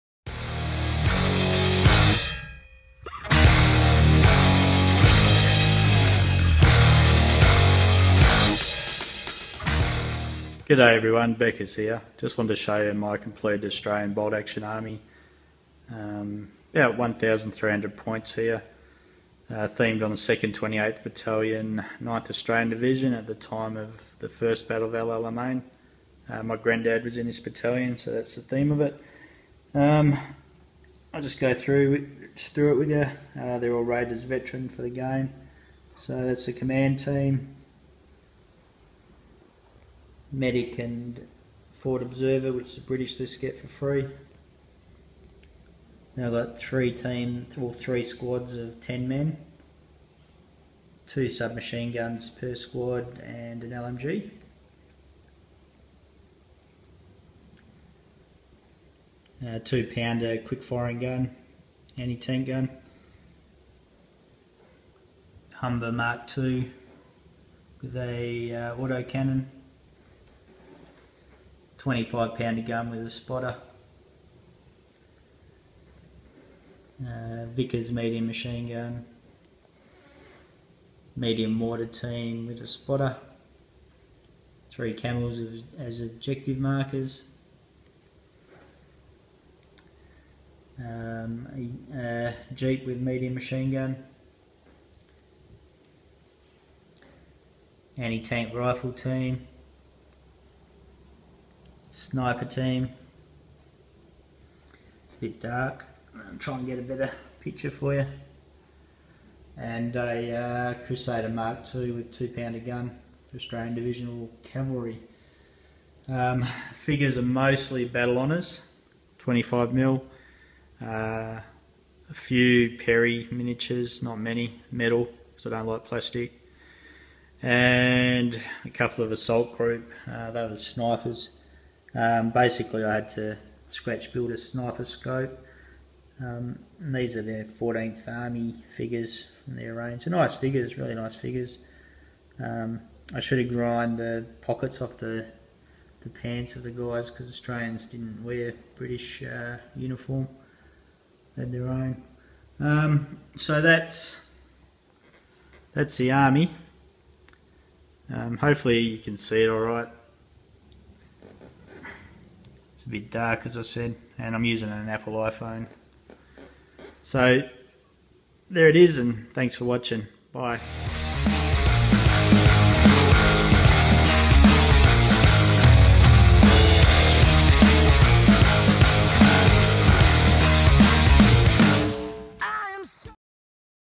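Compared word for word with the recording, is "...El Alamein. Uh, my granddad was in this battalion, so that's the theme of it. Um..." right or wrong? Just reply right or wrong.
right.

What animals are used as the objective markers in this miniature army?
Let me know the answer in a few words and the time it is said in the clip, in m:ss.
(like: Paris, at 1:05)
Camels, at 1:24.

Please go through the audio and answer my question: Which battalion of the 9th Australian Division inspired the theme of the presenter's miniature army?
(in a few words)
2nd 28th Battalion.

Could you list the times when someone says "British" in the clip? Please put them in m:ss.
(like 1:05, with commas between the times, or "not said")
0:42, 2:28.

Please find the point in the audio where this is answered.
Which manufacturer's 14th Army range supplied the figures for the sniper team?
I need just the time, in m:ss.
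2:09.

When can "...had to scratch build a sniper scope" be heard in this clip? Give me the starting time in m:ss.
2:12.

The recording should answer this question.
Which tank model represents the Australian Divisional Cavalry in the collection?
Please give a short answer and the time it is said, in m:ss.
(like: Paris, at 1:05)
Crusader Mark II, at 1:50.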